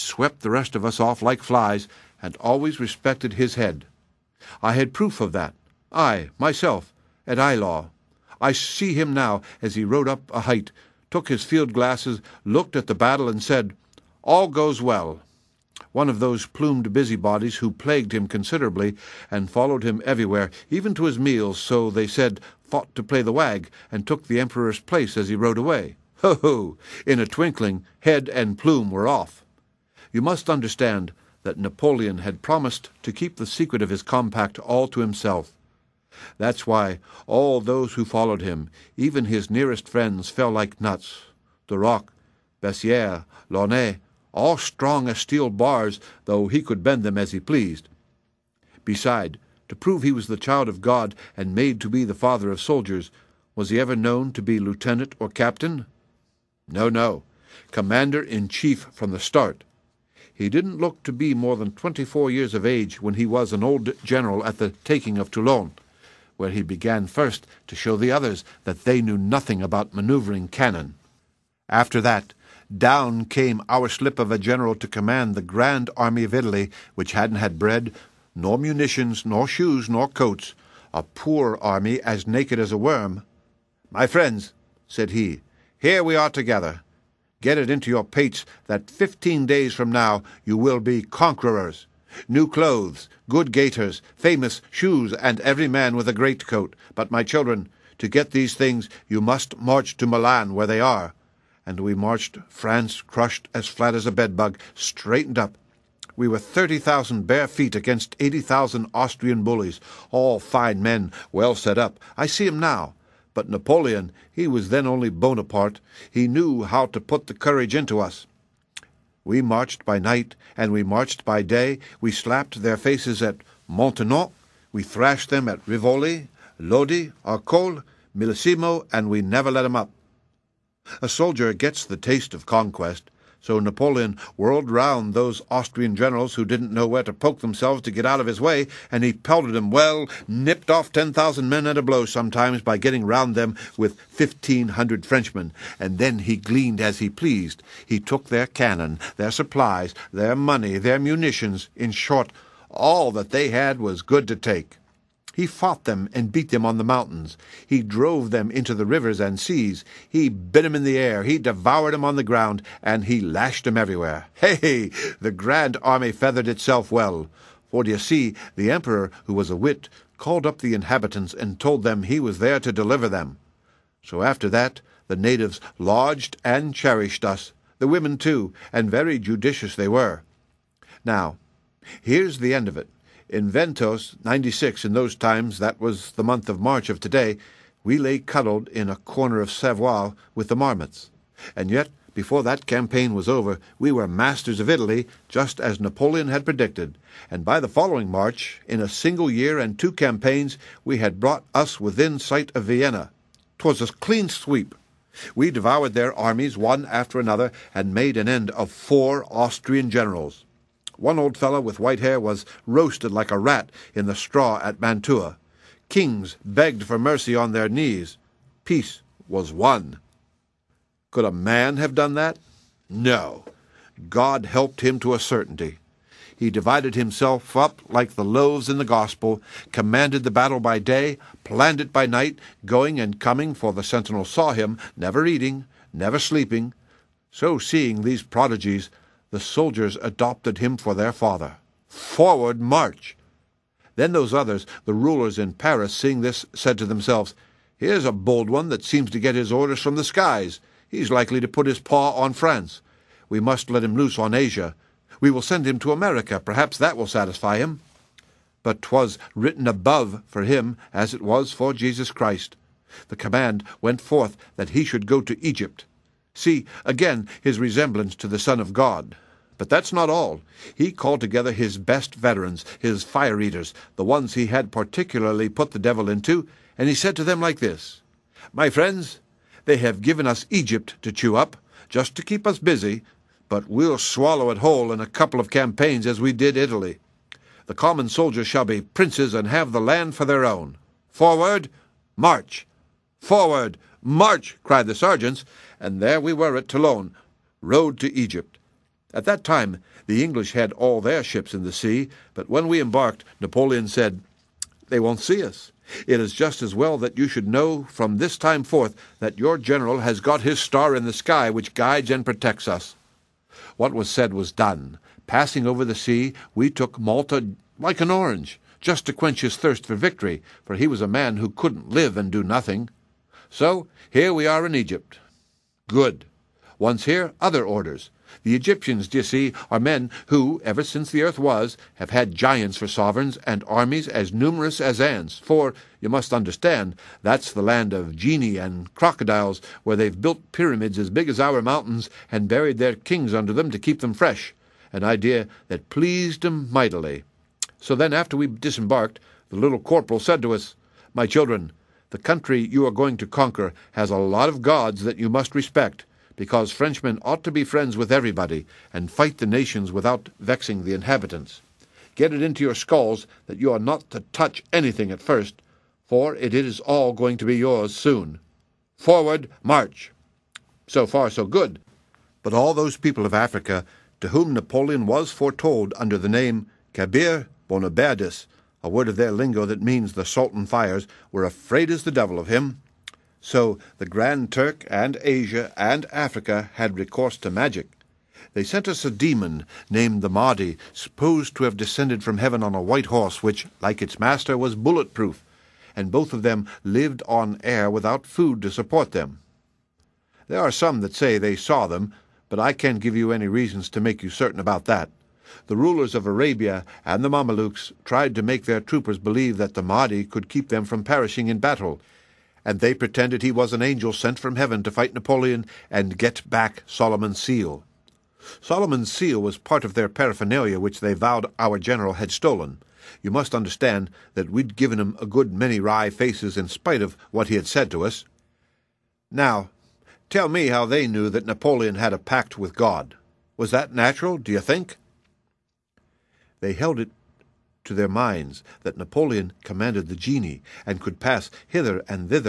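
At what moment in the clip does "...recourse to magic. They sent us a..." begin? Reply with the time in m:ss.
6:26.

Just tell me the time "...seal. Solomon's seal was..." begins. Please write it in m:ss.
6:57.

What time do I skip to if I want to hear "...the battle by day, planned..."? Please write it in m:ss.
3:50.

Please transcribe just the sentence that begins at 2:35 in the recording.
He fought them and beat them on the mountains.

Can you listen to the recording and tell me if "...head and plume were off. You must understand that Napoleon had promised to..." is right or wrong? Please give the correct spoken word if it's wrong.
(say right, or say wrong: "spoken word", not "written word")
right.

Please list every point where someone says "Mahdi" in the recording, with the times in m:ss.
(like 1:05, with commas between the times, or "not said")
6:30, 6:49.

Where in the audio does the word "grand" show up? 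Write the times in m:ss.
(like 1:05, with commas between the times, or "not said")
1:15, 2:45, 6:24.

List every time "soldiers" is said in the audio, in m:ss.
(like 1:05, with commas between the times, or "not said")
0:52, 2:11, 3:59, 4:48.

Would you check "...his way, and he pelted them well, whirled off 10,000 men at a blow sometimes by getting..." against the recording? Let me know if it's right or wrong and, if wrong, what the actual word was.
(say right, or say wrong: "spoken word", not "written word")
wrong: "nipped", not "whirled".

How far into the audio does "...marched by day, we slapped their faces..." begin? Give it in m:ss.
2:00.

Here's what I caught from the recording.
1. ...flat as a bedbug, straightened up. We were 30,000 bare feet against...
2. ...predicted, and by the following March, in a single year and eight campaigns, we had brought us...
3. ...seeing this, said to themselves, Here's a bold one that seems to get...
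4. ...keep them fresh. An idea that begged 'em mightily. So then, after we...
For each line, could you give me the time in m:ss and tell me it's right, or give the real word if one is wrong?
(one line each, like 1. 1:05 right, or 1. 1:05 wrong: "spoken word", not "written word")
1. 1:43 right
2. 3:16 wrong: "two", not "eight"
3. 4:05 right
4. 5:43 wrong: "pleased", not "begged".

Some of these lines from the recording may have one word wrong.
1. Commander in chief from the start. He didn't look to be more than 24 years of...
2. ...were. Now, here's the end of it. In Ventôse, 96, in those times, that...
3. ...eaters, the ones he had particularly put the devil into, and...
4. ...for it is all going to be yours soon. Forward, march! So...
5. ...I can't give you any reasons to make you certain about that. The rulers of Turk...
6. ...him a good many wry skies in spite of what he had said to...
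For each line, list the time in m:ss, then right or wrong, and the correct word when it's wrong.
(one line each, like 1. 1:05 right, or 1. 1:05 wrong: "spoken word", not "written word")
1. 0:57 right
2. 2:59 right
3. 4:33 right
4. 6:06 right
5. 6:42 wrong: "Arabia", not "Turk"
6. 7:04 wrong: "faces", not "skies".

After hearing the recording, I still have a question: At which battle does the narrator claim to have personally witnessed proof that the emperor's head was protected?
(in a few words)
Eylau.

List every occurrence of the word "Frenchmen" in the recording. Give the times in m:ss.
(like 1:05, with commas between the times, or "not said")
2:25, 5:56.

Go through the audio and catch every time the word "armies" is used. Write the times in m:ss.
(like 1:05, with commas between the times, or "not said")
3:26, 5:33.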